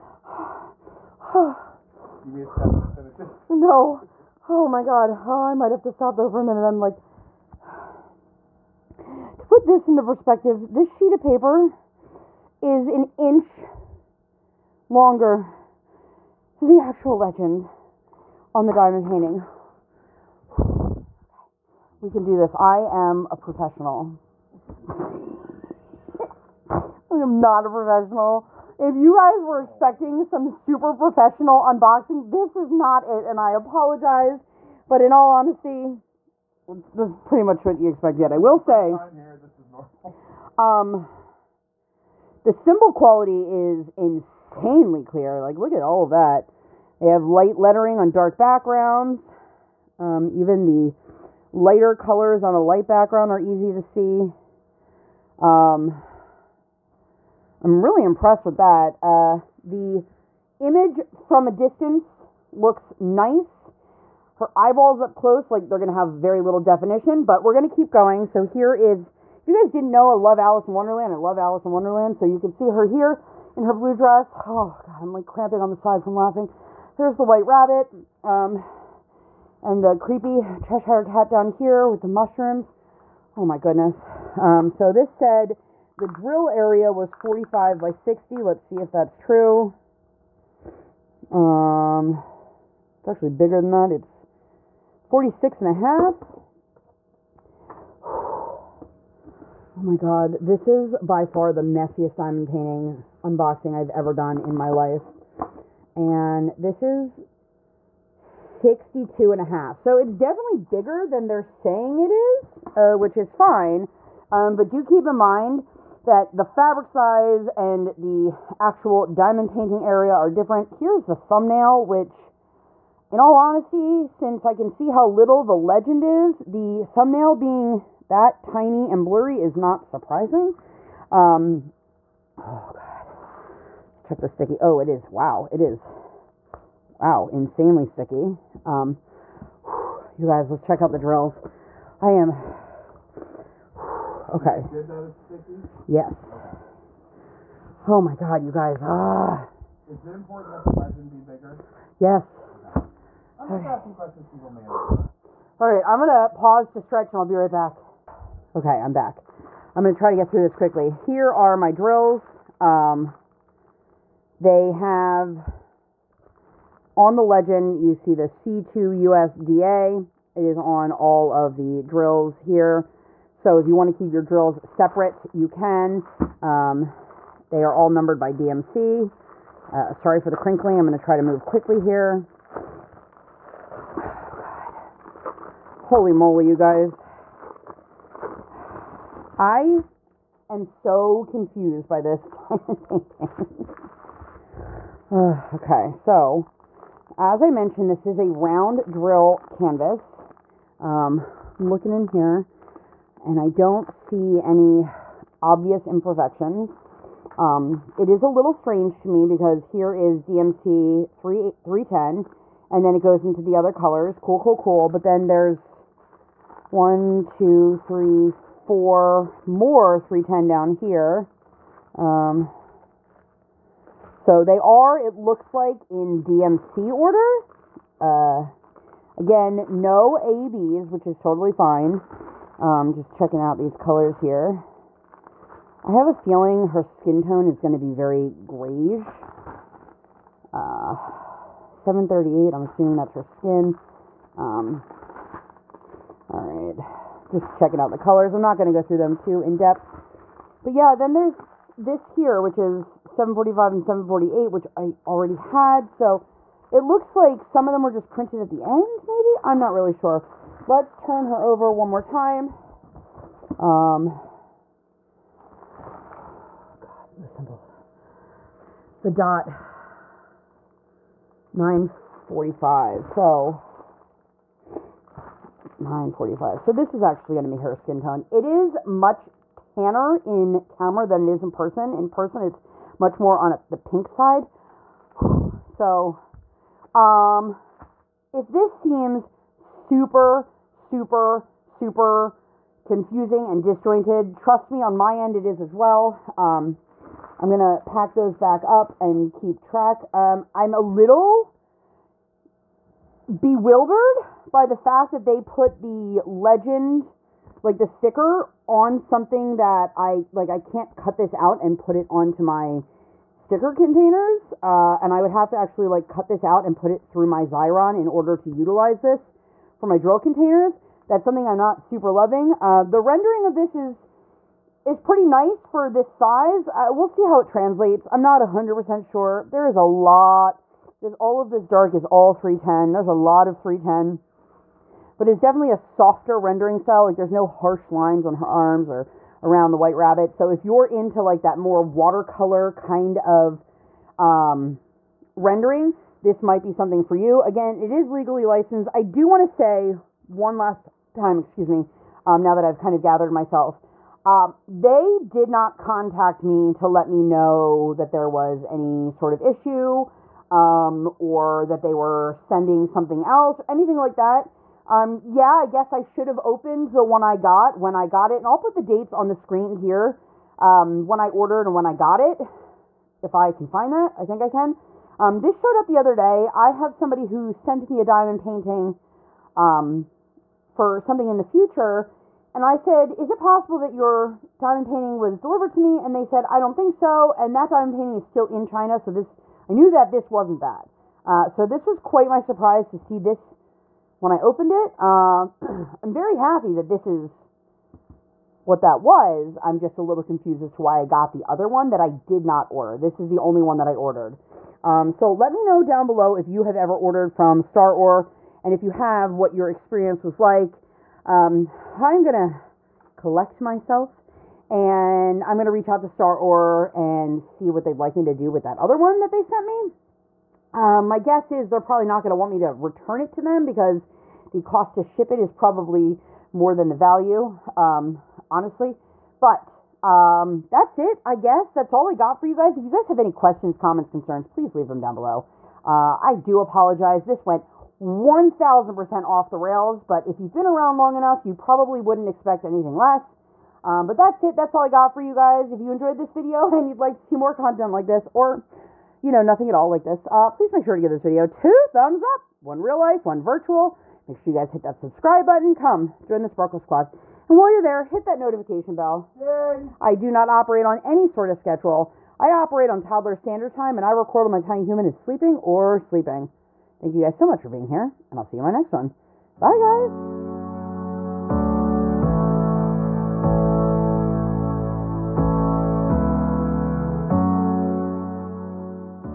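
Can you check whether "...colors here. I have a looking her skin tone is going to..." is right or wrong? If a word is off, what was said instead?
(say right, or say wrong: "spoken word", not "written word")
wrong: "feeling", not "looking".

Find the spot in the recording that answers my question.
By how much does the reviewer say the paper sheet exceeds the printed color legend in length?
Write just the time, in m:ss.
0:12.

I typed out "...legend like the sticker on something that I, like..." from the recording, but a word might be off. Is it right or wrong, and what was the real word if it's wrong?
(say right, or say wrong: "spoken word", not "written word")
right.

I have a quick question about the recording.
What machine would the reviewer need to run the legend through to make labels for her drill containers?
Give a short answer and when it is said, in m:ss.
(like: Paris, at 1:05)
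Xyron, at 5:17.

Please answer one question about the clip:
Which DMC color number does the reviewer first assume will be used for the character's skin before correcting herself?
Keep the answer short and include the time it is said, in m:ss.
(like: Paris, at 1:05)
738, at 4:01.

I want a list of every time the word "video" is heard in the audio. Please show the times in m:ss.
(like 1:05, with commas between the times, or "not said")
7:26, 7:31.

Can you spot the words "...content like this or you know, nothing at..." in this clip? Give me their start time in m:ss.
7:27.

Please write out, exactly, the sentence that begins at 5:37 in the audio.
Like there's no harsh lines on her arms or around the White Rabbit.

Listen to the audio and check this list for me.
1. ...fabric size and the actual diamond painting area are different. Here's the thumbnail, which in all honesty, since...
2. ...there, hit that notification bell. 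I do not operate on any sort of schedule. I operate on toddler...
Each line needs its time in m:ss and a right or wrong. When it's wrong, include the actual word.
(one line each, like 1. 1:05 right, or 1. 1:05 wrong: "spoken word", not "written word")
1. 1:56 right
2. 7:37 right.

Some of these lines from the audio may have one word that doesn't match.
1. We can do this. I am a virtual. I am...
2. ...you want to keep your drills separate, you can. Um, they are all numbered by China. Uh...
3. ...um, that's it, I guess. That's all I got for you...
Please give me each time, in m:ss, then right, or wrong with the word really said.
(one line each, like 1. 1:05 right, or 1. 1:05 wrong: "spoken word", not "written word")
1. 0:22 wrong: "professional", not "virtual"
2. 2:53 wrong: "DMC", not "China"
3. 7:10 right.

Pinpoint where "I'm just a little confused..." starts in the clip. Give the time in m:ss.
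6:39.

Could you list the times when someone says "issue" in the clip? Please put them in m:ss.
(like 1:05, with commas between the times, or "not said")
5:59.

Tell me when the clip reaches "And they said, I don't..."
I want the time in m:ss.
6:25.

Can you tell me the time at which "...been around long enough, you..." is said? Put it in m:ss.
7:20.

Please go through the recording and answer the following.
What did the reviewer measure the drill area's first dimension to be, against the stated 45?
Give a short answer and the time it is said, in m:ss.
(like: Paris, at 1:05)
46 and a half, at 1:35.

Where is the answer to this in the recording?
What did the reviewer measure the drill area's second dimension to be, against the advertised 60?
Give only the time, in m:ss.
1:48.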